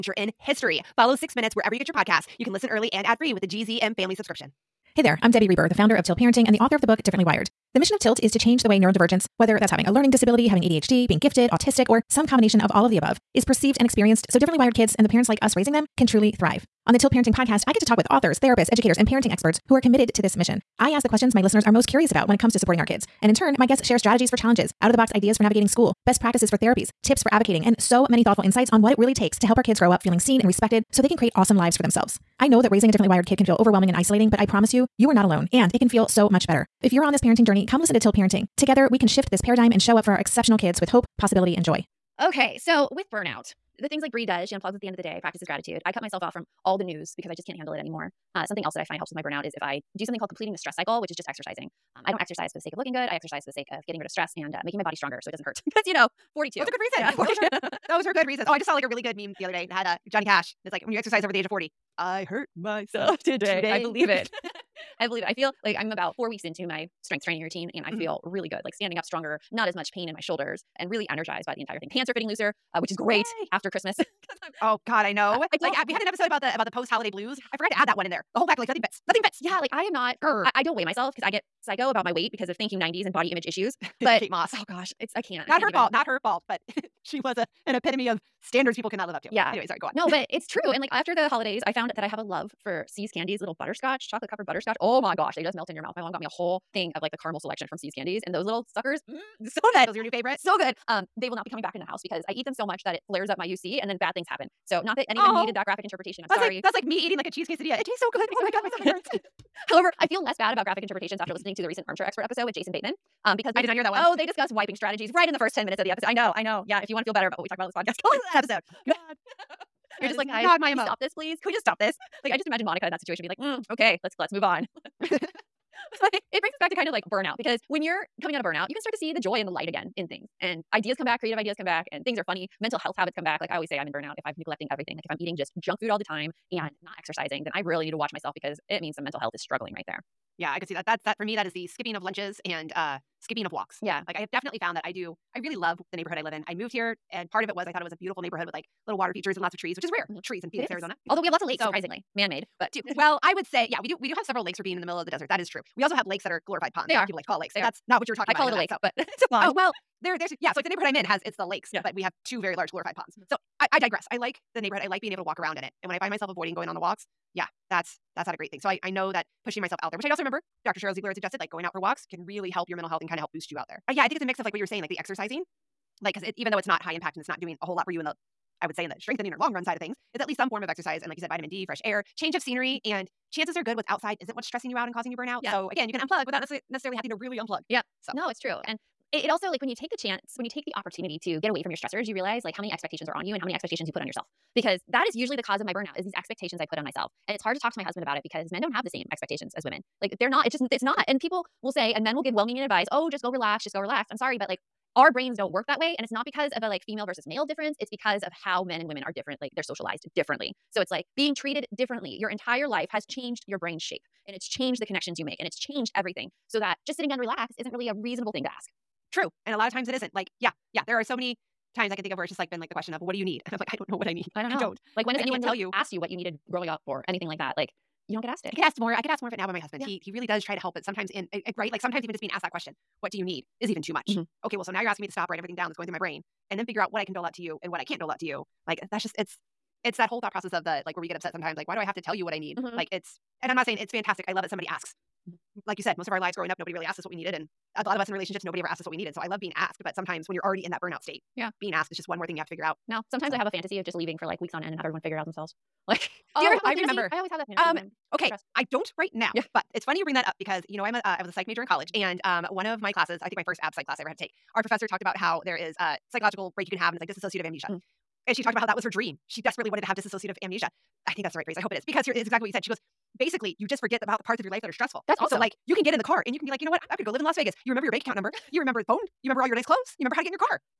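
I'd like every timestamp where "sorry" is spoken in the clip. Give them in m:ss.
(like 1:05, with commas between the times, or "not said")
1:29, 1:46, 3:24.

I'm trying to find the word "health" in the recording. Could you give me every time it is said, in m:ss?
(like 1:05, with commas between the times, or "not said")
2:12, 2:19, 2:52.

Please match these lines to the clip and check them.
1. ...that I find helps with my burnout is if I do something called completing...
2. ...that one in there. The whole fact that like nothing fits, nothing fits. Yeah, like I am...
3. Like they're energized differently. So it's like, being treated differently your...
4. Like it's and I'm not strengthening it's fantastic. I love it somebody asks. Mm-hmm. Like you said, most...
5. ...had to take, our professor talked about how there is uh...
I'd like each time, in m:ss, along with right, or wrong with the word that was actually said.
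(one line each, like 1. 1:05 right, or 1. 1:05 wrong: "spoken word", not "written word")
1. 0:48 right
2. 1:17 right
3. 3:29 wrong: "socialized", not "energized"
4. 4:02 wrong: "saying", not "strengthening"
5. 4:24 right.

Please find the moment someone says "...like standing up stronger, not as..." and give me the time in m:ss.
1:08.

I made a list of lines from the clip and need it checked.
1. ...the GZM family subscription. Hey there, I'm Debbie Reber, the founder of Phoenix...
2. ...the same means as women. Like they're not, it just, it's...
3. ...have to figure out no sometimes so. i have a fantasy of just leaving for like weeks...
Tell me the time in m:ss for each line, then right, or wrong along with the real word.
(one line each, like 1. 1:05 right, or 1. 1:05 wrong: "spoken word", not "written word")
1. 0:03 wrong: "Tilt", not "Phoenix"
2. 3:18 wrong: "expectations", not "means"
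3. 4:12 right.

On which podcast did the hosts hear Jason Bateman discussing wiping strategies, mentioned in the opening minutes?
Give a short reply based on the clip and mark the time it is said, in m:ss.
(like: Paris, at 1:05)
Armchair Expert, at 1:51.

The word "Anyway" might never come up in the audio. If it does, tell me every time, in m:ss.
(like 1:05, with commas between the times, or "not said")
1:29.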